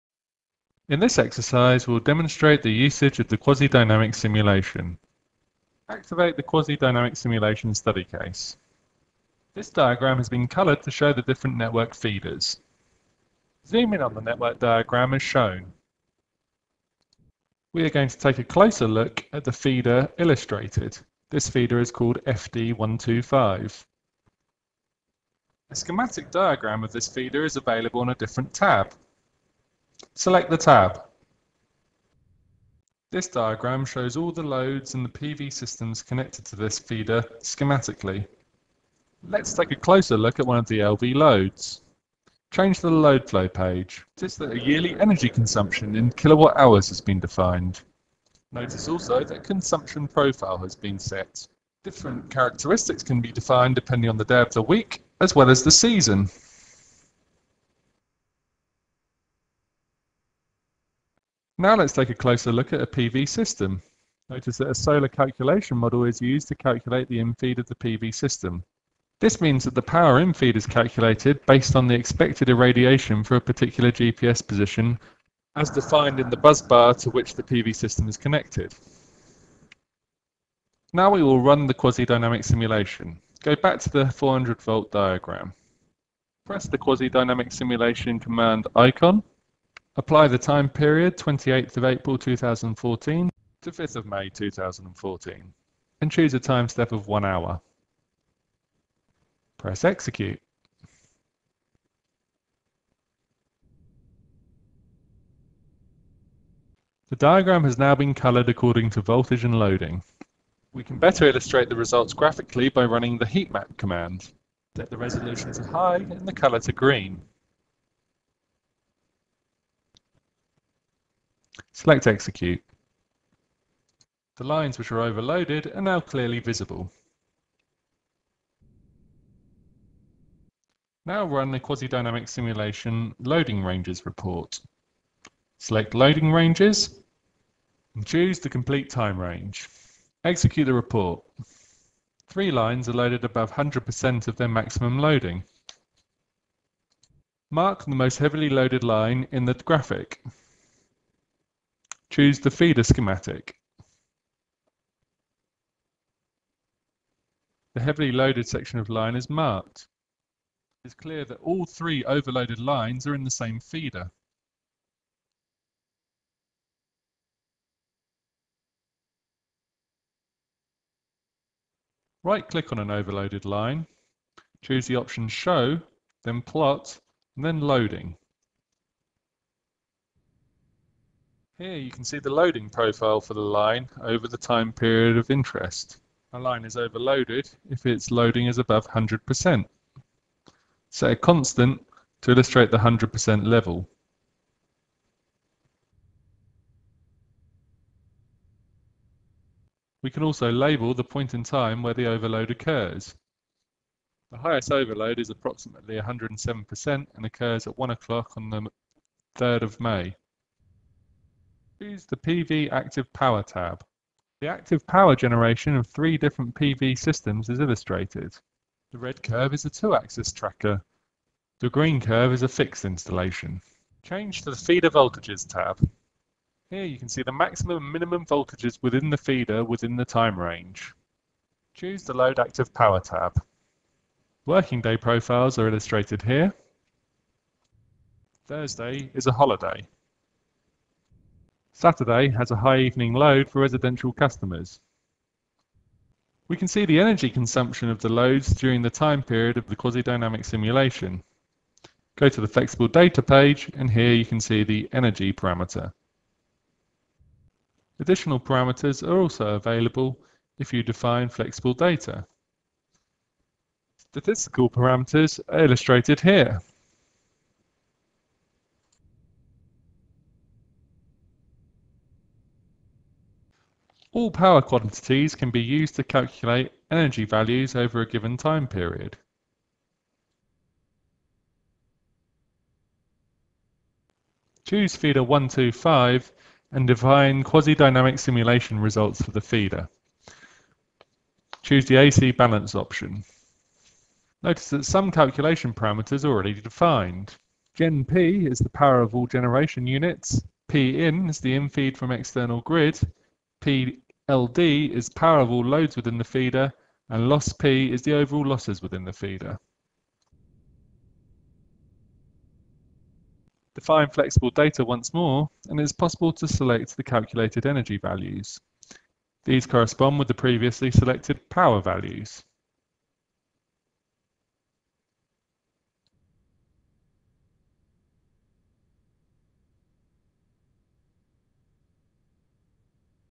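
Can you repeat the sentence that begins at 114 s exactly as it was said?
Set the resolution to high and the color to green.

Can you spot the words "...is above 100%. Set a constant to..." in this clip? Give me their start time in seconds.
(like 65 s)
188 s.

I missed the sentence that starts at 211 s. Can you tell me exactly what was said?
Choose the PV Active Power tab.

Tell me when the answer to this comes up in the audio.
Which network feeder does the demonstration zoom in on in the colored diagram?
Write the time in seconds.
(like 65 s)
22 s.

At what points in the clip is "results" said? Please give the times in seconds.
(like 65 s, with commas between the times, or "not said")
111 s, 288 s.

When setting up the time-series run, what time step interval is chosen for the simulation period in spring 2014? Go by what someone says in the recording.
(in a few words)
1 hour.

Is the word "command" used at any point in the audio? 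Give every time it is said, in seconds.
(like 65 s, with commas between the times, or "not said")
88 s, 113 s.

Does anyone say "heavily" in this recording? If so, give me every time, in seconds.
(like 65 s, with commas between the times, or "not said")
148 s, 157 s.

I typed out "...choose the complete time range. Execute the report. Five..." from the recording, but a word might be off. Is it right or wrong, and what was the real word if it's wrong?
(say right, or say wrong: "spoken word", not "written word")
wrong: "Three", not "Five".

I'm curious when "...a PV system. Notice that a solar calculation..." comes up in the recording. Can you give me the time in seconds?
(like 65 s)
62 s.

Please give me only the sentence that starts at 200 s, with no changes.
We can also label the point in time where the overload occurs.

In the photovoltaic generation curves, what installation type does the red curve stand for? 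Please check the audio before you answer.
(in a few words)
two-axis tracker.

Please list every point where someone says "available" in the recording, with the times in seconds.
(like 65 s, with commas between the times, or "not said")
27 s, 259 s.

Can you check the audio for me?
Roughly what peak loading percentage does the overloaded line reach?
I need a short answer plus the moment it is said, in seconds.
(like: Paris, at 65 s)
107%, at 205 s.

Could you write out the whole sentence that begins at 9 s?
This diagram has been colored to show the different network feeders.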